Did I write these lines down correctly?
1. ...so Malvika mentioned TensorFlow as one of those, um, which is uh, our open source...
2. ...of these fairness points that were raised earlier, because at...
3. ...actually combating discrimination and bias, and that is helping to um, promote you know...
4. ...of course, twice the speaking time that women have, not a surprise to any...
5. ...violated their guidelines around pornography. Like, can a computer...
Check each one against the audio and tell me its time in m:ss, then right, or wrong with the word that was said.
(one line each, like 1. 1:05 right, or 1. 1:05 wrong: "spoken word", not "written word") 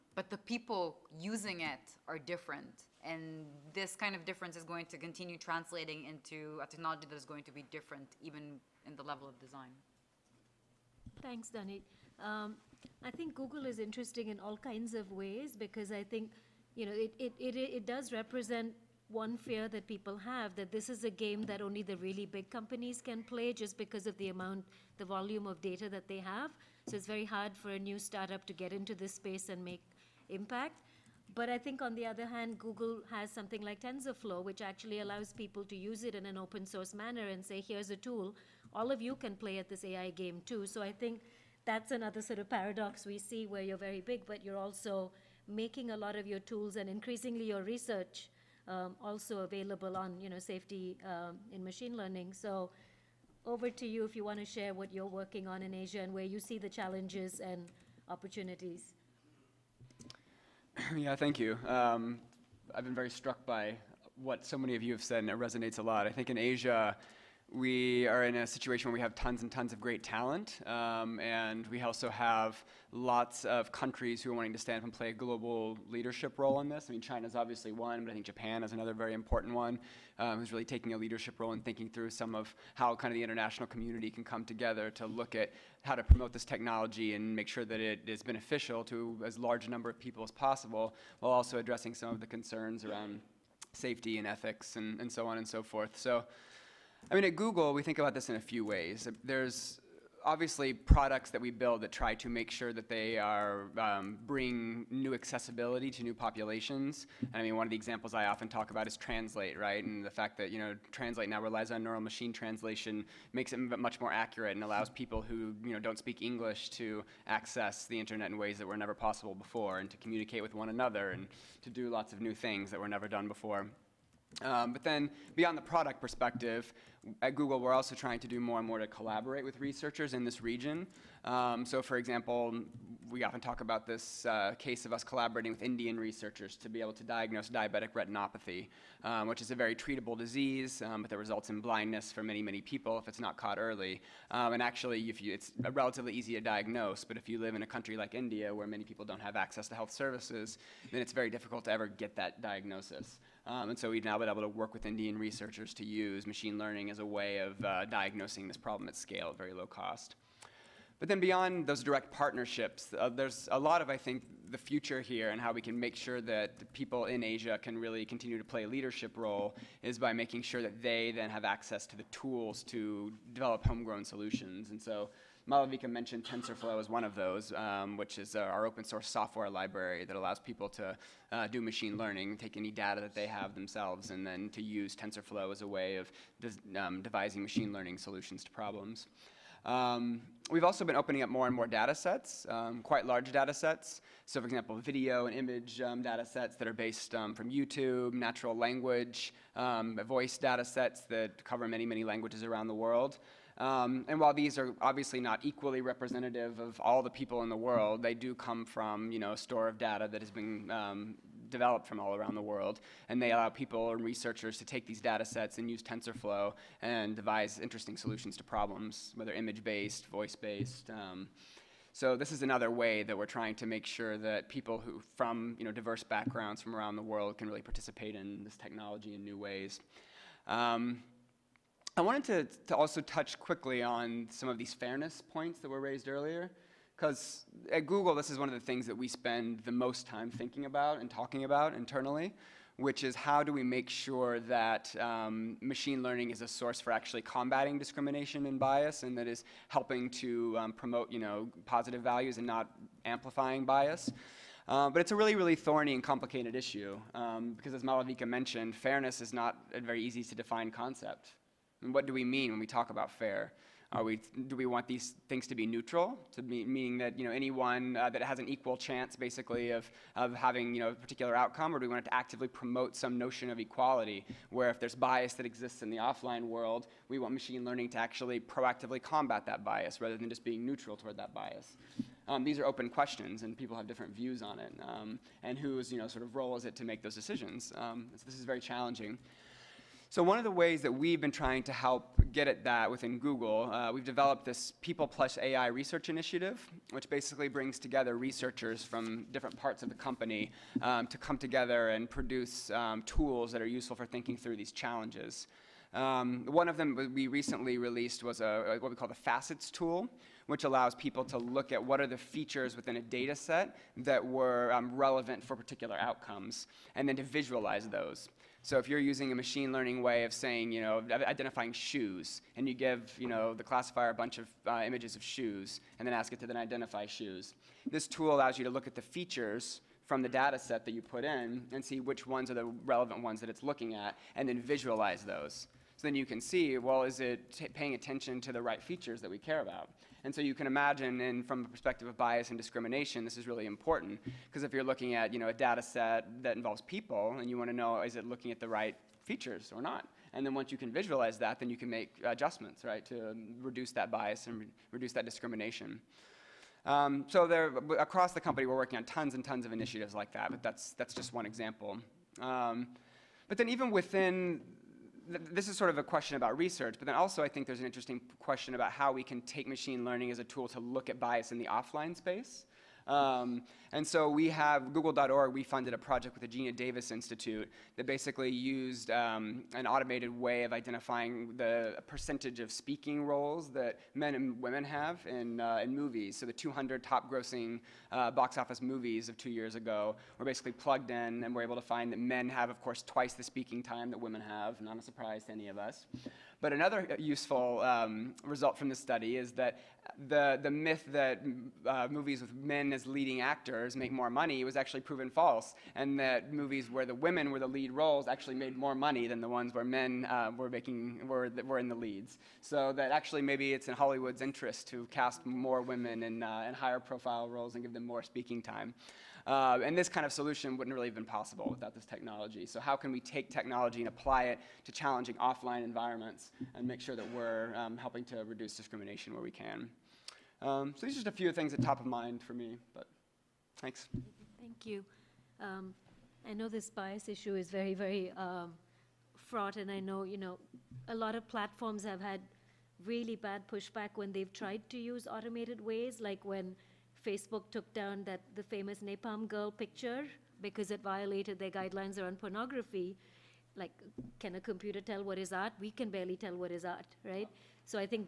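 1. 2:54 right
2. 3:54 right
3. 4:06 right
4. 6:32 right
5. 7:31 right.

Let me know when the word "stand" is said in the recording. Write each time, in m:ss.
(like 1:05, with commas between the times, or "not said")
1:14.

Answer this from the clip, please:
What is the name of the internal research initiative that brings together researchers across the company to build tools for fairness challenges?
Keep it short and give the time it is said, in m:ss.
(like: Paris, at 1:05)
People Plus AI Research Initiative, at 4:54.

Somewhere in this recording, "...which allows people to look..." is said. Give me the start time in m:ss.
5:10.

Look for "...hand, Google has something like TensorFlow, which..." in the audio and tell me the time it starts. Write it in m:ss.
0:32.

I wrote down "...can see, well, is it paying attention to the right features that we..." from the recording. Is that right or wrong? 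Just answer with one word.
right.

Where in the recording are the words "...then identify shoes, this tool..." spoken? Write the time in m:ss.
5:26.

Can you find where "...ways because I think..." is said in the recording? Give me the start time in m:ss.
0:15.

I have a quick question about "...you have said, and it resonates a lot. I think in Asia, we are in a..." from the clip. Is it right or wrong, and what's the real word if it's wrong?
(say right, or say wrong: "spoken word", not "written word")
right.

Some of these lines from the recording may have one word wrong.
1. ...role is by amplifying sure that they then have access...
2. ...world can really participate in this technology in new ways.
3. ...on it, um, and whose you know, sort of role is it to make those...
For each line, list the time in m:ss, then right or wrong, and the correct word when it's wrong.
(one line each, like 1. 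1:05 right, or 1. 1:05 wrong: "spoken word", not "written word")
1. 2:49 wrong: "making", not "amplifying"
2. 3:47 right
3. 4:44 right.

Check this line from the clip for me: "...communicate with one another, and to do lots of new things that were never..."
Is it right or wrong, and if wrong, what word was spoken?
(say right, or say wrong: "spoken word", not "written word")
right.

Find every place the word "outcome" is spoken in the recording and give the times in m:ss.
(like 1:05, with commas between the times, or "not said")
4:31, 5:15.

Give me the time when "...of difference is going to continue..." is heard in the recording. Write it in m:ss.
0:04.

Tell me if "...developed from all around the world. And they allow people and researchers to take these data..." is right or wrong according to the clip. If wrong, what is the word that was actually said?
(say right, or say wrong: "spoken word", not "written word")
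right.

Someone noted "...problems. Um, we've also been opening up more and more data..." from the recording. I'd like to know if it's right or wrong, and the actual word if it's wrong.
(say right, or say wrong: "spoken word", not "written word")
right.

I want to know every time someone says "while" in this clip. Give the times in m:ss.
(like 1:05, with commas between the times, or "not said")
1:31, 3:24.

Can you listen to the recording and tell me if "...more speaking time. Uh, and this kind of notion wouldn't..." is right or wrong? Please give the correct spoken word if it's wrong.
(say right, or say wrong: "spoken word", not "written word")
wrong: "solution", not "notion".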